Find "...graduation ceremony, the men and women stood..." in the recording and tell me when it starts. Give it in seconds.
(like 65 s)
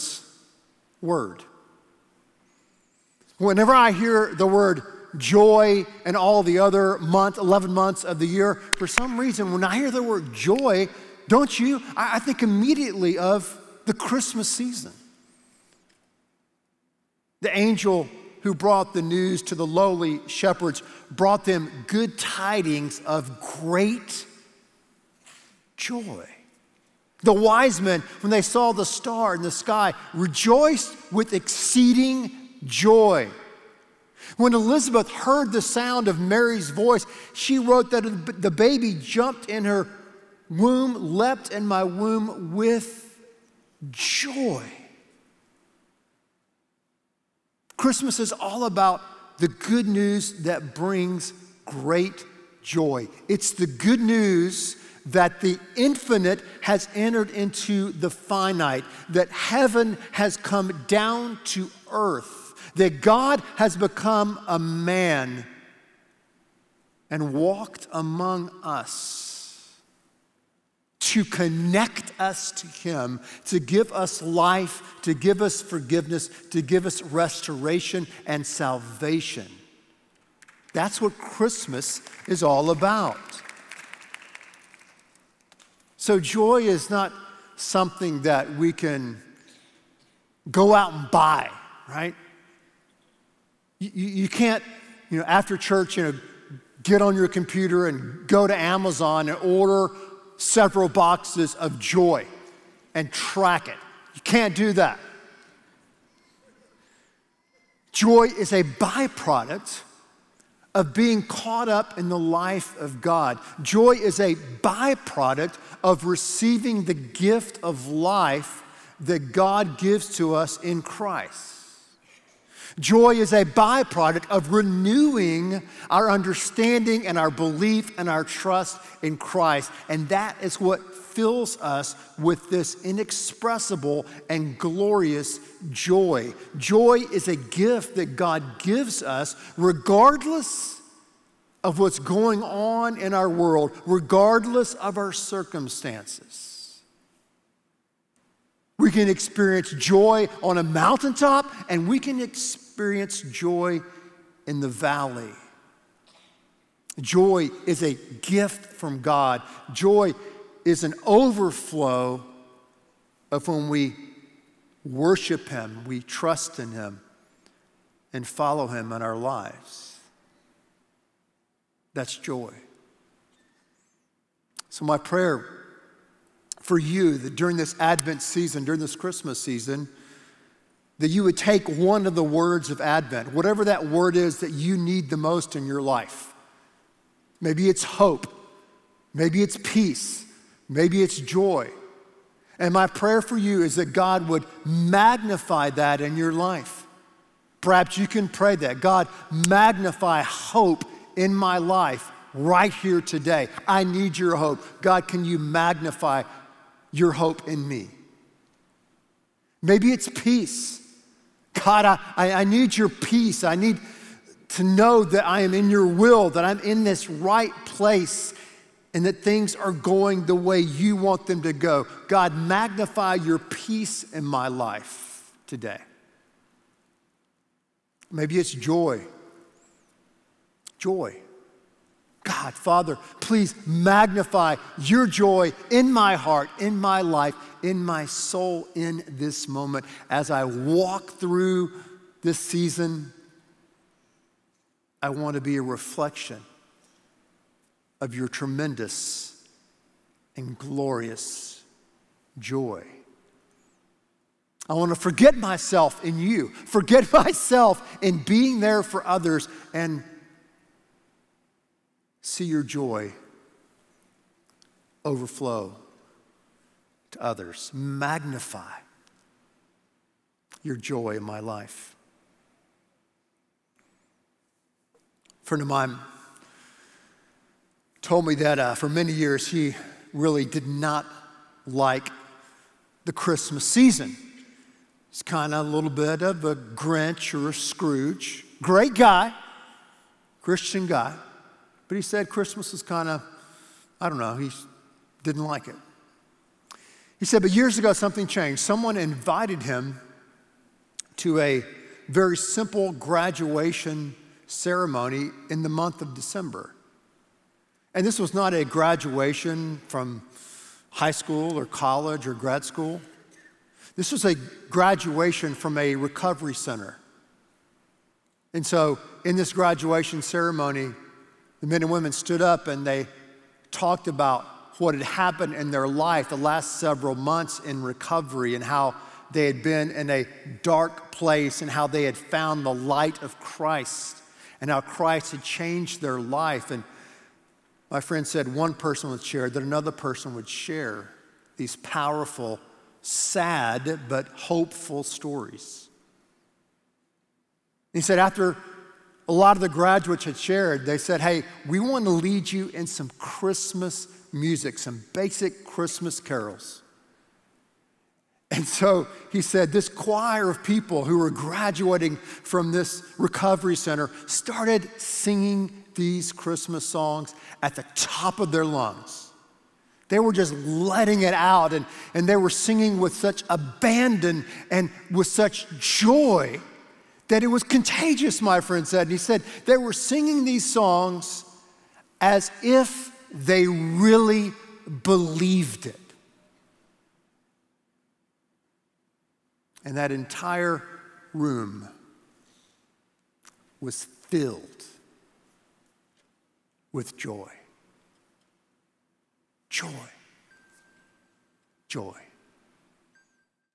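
319 s.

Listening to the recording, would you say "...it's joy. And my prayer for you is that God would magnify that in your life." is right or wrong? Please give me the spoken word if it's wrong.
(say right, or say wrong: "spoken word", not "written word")
right.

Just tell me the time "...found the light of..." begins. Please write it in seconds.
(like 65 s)
332 s.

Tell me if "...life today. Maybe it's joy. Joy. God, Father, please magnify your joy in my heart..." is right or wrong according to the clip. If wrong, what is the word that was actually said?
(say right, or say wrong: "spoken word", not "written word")
right.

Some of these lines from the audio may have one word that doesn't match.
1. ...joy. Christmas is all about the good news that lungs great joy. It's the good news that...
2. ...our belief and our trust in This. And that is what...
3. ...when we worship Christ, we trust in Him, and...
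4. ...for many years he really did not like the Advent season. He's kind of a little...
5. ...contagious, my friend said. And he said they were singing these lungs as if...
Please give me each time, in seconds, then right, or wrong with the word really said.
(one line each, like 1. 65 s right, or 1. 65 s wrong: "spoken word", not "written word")
1. 43 s wrong: "brings", not "lungs"
2. 127 s wrong: "Christ", not "This"
3. 163 s wrong: "Him", not "Christ"
4. 278 s wrong: "Christmas", not "Advent"
5. 377 s wrong: "songs", not "lungs".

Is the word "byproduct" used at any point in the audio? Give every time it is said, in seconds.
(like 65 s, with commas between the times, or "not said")
108 s, 114 s, 123 s.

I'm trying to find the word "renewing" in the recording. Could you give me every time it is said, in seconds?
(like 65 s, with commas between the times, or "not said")
124 s.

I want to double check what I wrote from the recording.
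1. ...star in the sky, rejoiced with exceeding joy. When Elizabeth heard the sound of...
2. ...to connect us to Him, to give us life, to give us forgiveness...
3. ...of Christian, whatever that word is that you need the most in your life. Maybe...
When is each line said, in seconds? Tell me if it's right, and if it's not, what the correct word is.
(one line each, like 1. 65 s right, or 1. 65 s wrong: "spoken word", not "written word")
1. 28 s right
2. 71 s right
3. 182 s wrong: "Advent", not "Christian".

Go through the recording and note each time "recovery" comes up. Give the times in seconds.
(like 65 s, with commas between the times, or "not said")
315 s, 327 s, 363 s.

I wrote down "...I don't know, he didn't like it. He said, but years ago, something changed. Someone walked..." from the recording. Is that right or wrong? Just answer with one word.
wrong.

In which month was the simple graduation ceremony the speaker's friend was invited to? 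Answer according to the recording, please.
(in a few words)
December.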